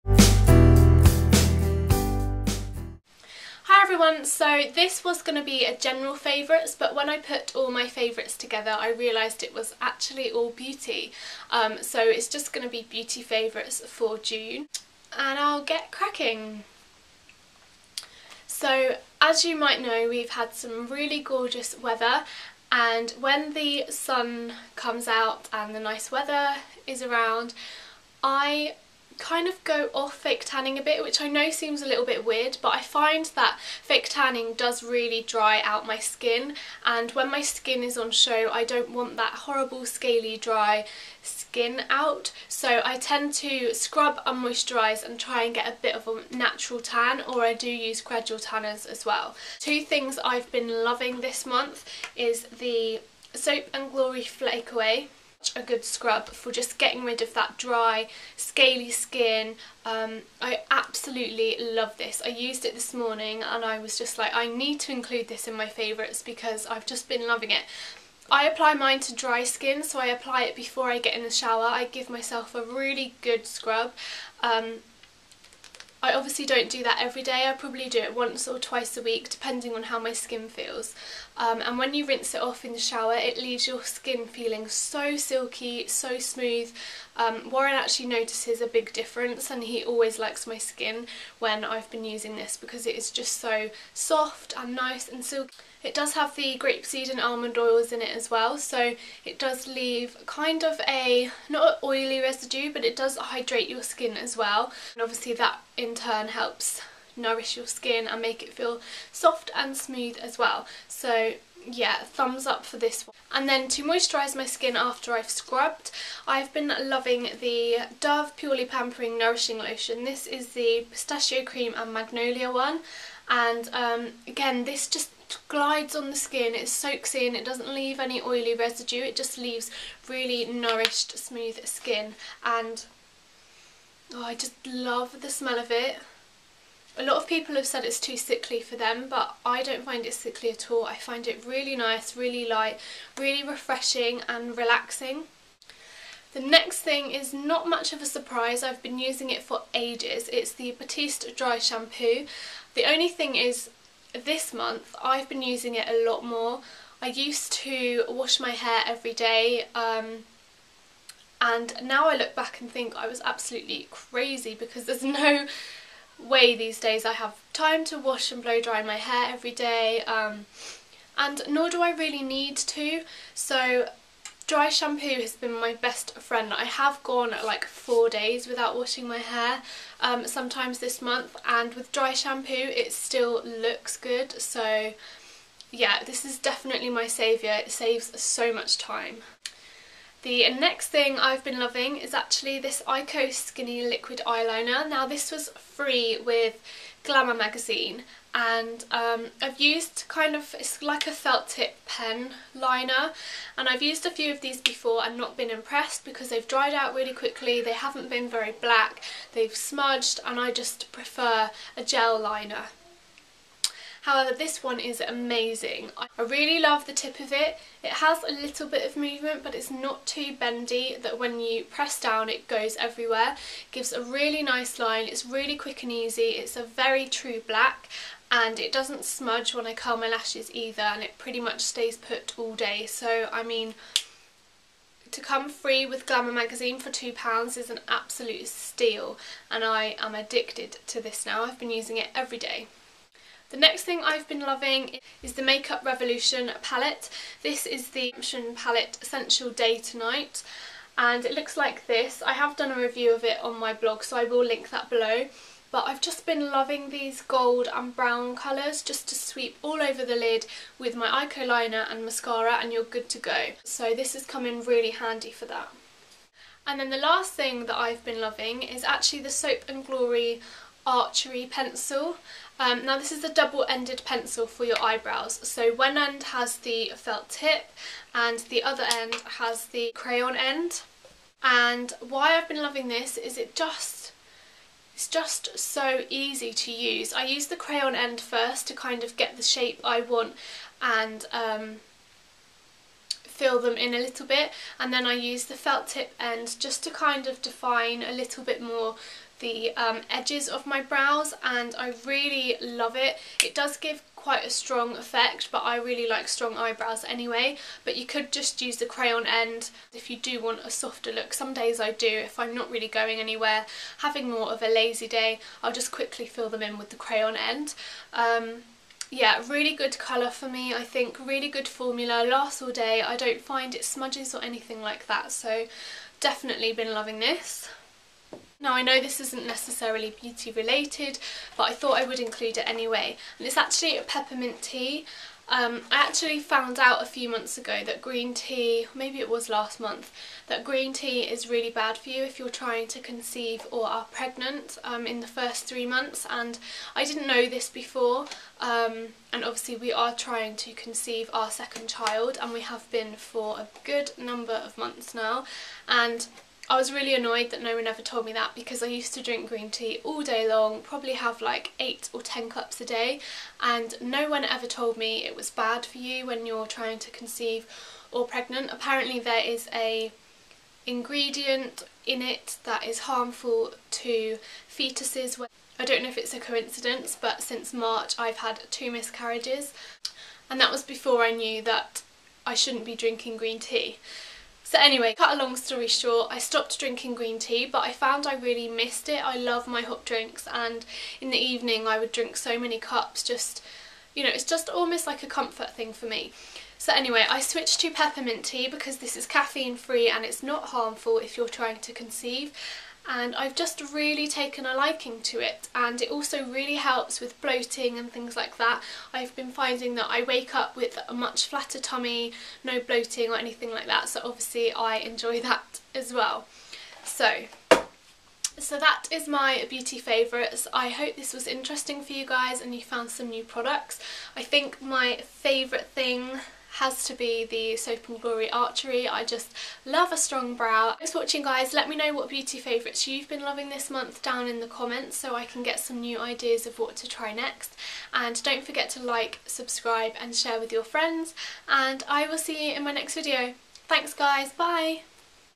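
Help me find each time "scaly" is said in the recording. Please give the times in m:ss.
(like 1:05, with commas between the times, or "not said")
0:39, 0:58.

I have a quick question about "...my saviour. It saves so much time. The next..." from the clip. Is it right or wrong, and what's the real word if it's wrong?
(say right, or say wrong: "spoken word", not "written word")
right.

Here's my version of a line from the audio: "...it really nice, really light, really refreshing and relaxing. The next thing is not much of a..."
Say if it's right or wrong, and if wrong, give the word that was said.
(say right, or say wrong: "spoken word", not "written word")
right.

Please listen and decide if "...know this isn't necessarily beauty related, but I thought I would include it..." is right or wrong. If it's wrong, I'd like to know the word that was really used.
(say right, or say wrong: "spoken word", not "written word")
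right.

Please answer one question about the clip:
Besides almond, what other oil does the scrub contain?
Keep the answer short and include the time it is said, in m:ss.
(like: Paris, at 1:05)
Grapeseed, at 1:36.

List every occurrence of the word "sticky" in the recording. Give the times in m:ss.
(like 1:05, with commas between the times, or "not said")
not said.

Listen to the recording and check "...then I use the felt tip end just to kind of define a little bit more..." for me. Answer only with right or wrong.
right.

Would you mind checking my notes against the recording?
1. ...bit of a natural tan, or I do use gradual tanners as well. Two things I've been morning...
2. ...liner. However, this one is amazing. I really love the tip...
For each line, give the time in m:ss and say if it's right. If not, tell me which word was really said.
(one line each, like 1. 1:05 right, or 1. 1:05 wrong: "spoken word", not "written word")
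1. 0:45 wrong: "loving", not "morning"
2. 3:32 right.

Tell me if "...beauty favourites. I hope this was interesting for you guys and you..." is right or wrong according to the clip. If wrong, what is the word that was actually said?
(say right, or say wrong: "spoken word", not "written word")
right.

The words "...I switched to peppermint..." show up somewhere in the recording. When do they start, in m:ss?
6:37.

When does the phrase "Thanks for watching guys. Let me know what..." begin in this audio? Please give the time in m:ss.
7:10.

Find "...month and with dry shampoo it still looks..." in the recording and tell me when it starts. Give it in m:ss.
3:01.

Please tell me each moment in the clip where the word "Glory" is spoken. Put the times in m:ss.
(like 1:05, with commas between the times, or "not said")
0:53, 4:29, 7:08.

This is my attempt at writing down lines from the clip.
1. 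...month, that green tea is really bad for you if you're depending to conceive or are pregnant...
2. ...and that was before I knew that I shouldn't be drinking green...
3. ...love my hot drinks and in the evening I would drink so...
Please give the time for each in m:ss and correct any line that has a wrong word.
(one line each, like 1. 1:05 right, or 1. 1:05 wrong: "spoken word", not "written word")
1. 5:39 wrong: "trying", not "depending"
2. 6:20 right
3. 6:29 right.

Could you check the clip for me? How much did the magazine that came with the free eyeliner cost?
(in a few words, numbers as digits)
£2.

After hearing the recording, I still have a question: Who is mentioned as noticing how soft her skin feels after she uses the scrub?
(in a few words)
Warren.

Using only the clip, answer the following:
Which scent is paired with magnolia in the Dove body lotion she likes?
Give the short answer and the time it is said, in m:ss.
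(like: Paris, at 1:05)
Pistachio cream, at 2:00.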